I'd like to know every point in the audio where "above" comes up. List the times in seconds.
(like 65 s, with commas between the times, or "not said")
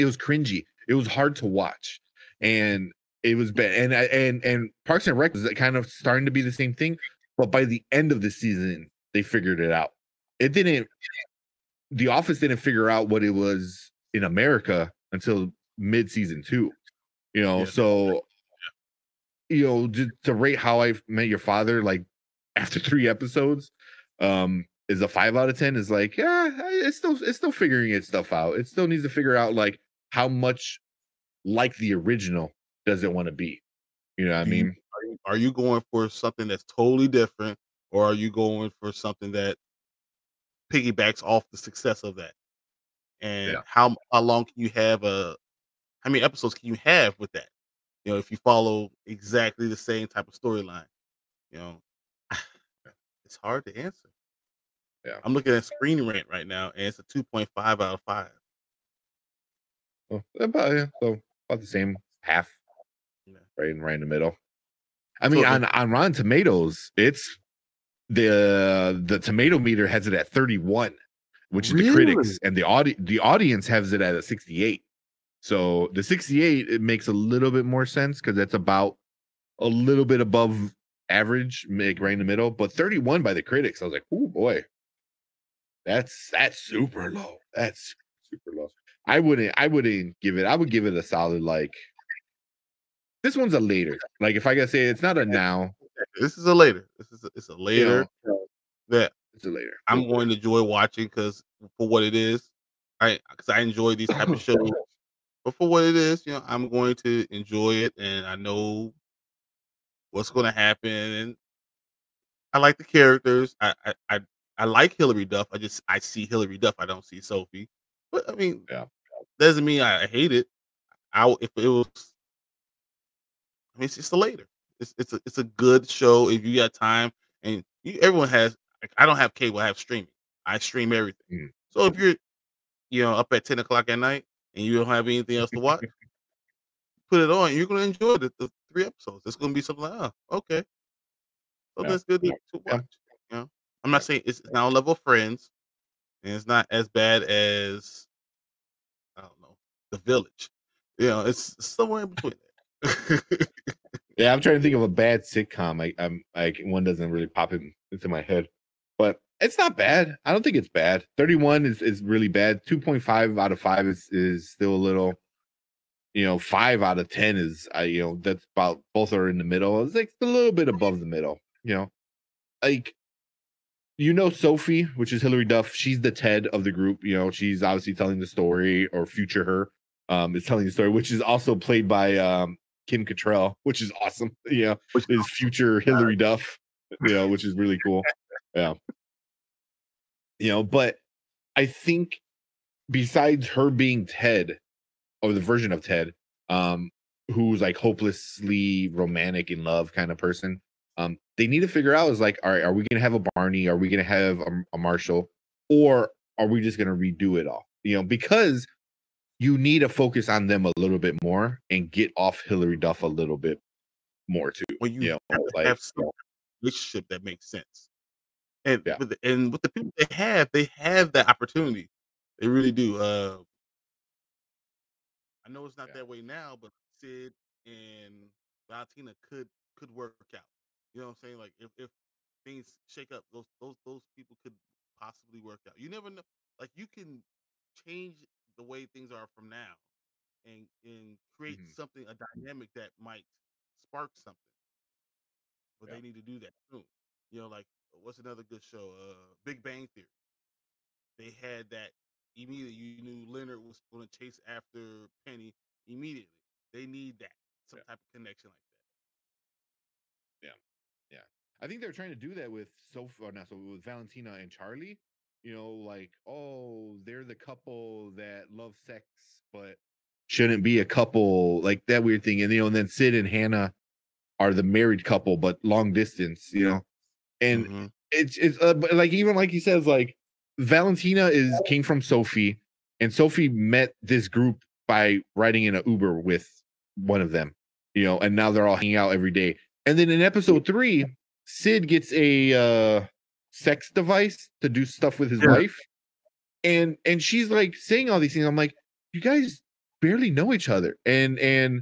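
80 s, 170 s.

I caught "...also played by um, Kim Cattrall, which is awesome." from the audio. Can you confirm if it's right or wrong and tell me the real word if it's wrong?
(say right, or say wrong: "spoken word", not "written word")
right.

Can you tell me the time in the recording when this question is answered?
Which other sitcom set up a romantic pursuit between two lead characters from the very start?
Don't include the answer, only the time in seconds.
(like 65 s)
249 s.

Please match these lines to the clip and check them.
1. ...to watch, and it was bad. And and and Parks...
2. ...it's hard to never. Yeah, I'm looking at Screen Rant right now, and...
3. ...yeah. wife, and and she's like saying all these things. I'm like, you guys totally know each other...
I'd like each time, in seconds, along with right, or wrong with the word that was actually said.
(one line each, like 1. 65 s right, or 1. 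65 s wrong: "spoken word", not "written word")
1. 1 s right
2. 53 s wrong: "answer", not "never"
3. 295 s wrong: "barely", not "totally".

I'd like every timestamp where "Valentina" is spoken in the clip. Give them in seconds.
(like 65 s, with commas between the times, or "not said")
228 s, 263 s, 280 s.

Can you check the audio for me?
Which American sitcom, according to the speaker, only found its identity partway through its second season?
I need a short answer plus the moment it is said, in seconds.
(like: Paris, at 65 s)
The Office, at 11 s.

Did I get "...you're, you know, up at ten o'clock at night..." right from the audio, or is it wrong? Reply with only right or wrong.
right.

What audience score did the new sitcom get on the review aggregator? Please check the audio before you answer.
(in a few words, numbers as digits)
68.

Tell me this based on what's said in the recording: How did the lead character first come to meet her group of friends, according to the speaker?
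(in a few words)
In an Uber.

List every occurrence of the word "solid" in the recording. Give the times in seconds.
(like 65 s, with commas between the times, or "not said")
91 s.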